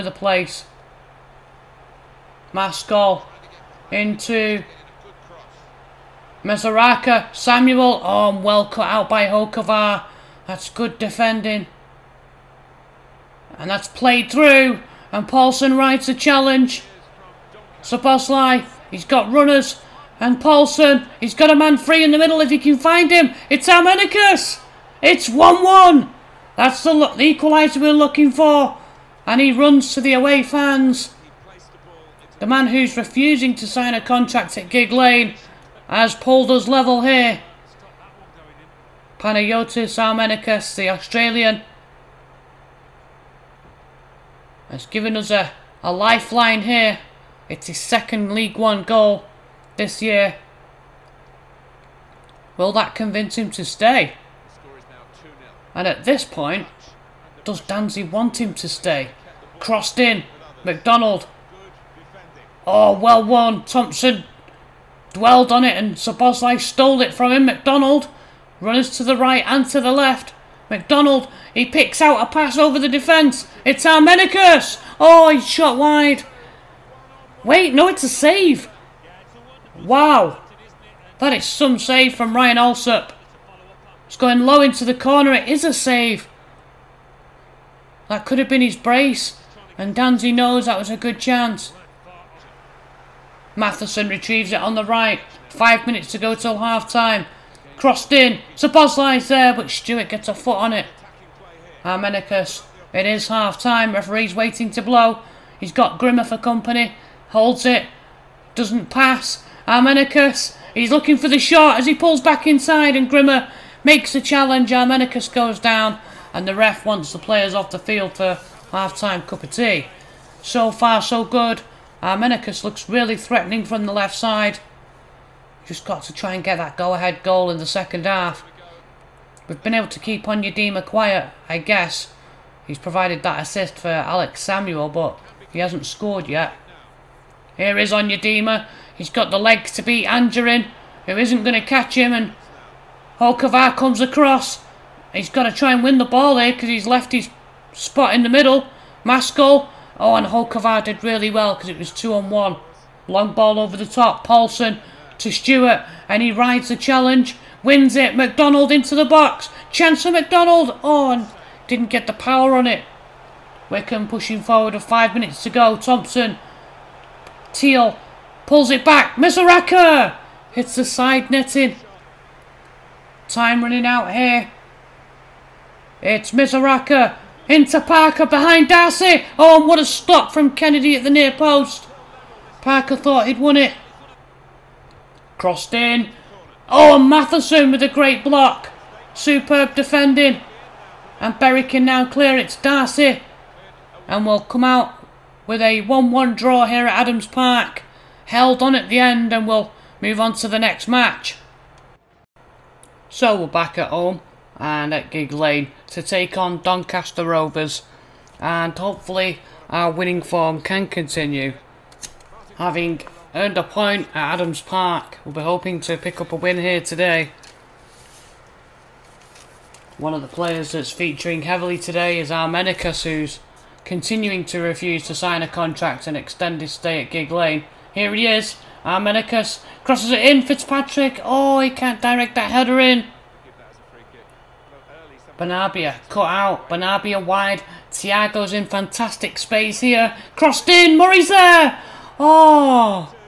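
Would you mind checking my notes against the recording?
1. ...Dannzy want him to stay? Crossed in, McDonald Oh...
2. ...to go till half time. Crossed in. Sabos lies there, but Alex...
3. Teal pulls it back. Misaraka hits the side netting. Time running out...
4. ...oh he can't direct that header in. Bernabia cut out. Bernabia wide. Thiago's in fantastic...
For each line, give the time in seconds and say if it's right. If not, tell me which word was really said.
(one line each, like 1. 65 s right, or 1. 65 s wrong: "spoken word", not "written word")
1. 57 s right
2. 96 s wrong: "Stewart", not "Alex"
3. 167 s right
4. 231 s right.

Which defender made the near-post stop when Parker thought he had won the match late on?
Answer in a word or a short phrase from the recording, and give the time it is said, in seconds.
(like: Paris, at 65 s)
Kennedy, at 180 s.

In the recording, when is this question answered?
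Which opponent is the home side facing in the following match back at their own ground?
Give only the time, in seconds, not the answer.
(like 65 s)
206 s.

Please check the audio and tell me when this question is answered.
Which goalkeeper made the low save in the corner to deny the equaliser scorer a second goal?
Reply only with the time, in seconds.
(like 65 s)
82 s.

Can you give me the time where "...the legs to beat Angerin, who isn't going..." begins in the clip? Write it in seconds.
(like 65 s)
139 s.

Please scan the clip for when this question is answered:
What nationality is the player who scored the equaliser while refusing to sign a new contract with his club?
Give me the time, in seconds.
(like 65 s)
40 s.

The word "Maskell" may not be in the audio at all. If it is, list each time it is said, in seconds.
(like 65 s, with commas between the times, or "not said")
2 s, 149 s.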